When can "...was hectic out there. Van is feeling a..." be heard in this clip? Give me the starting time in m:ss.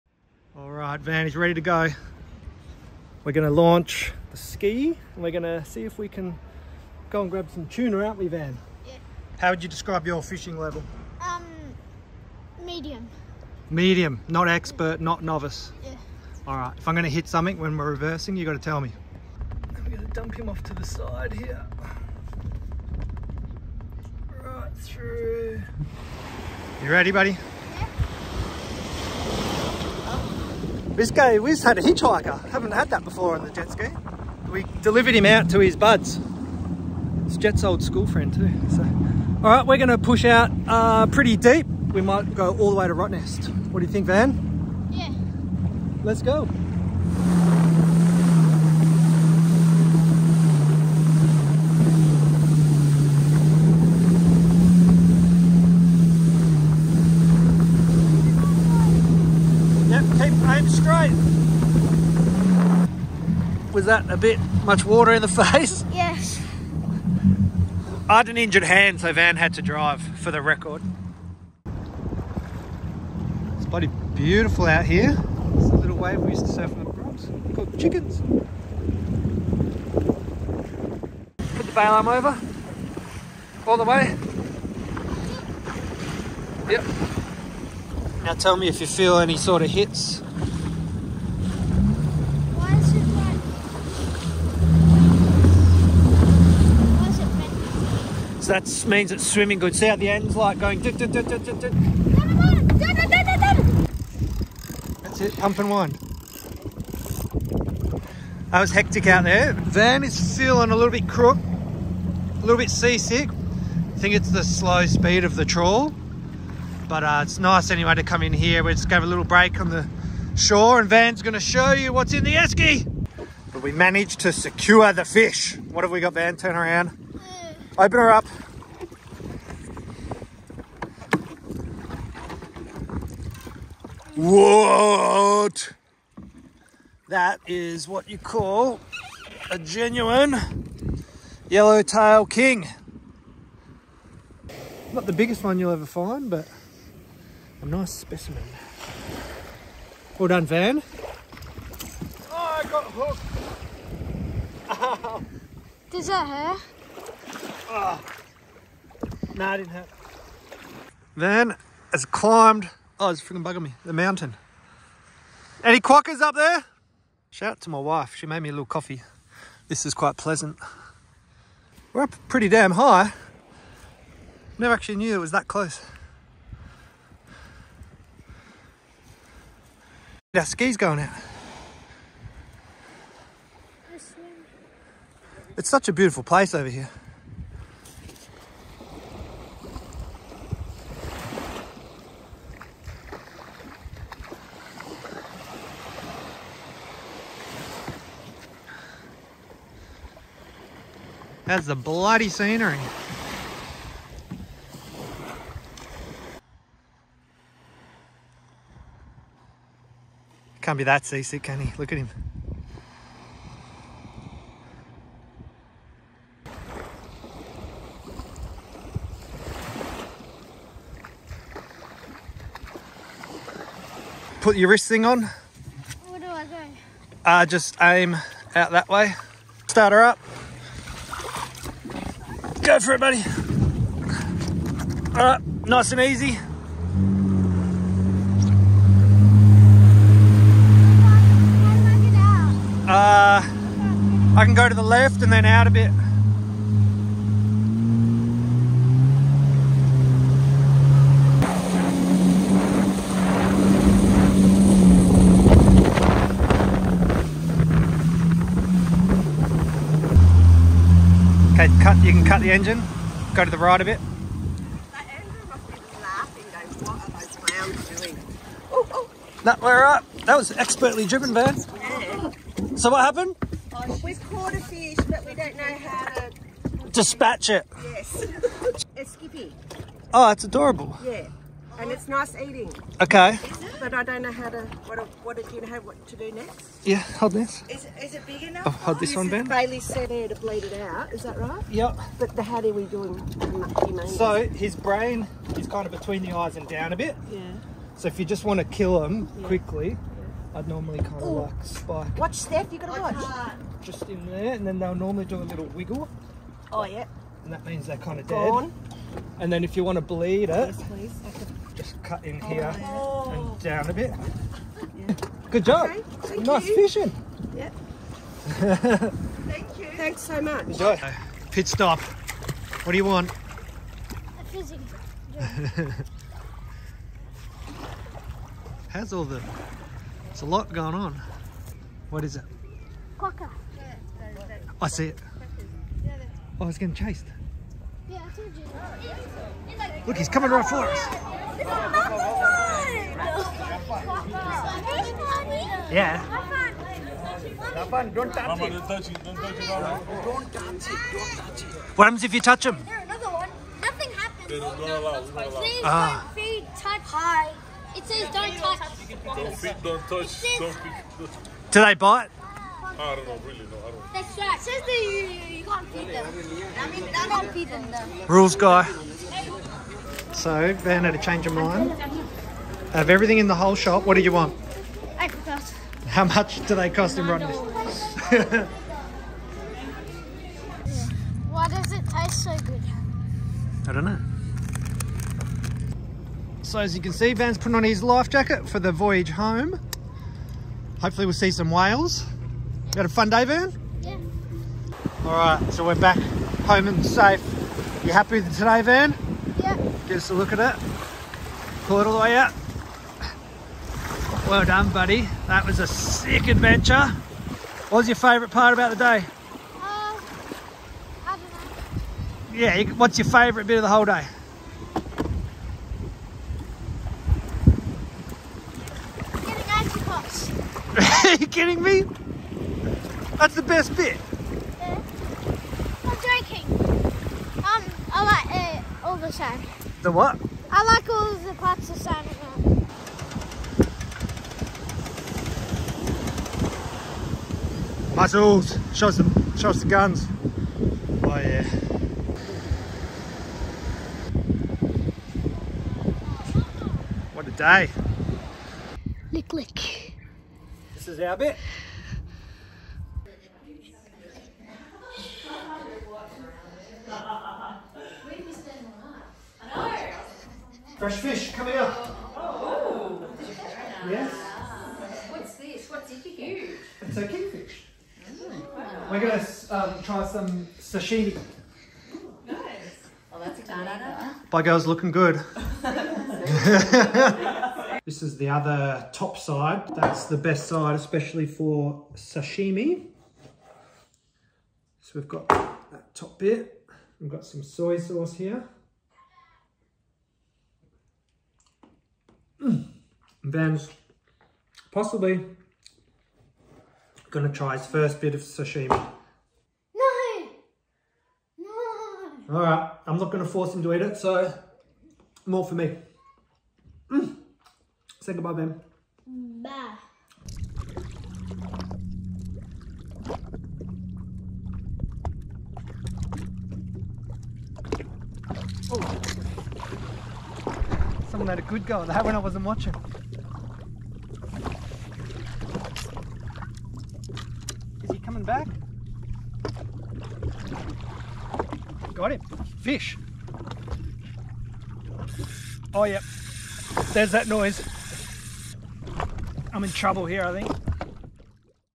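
1:48.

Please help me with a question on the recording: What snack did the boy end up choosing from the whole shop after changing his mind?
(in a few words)
Apricots.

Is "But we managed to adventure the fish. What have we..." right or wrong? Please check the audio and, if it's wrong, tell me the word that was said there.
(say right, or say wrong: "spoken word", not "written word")
wrong: "secure", not "adventure".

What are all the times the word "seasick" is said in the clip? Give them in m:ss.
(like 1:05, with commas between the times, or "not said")
1:52, 3:31.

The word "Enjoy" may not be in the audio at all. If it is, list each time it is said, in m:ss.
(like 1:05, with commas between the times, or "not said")
5:20.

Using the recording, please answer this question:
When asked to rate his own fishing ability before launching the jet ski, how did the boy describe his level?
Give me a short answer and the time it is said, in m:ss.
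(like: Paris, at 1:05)
Medium, at 0:11.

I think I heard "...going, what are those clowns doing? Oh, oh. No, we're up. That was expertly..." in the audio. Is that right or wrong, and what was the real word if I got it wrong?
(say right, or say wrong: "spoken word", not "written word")
right.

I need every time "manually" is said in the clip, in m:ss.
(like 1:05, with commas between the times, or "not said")
not said.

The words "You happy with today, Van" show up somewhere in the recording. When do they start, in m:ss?
6:38.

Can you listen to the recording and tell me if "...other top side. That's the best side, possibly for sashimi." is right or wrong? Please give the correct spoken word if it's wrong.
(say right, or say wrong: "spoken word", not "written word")
wrong: "especially", not "possibly".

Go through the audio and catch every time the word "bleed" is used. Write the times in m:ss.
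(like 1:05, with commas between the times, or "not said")
4:50, 5:10.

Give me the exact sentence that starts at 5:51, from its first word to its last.
What happens if you touch him?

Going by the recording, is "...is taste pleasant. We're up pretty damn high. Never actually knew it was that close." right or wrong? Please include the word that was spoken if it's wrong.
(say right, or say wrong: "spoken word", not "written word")
wrong: "quite", not "taste".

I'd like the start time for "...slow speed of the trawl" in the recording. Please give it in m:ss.
1:54.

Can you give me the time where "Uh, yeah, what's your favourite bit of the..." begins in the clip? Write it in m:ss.
6:49.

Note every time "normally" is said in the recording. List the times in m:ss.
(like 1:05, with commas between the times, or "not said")
5:00, 5:04.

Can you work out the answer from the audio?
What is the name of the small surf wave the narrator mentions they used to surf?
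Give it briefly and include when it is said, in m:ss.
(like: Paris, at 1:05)
Chickens, at 1:17.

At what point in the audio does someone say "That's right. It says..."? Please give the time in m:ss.
6:04.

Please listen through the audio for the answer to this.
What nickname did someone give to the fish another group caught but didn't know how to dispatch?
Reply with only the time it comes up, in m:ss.
4:39.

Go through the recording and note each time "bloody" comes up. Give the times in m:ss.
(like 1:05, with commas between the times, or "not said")
1:13, 3:21.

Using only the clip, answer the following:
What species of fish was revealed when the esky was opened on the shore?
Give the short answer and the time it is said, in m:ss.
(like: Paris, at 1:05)
Yellowtail king, at 2:21.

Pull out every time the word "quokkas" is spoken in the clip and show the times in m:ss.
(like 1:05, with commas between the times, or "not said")
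2:45, 5:33.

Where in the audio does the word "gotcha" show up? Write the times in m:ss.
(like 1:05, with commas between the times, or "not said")
not said.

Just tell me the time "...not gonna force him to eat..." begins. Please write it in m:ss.
8:23.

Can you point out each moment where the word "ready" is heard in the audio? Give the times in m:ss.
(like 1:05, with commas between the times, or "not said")
0:01, 0:26.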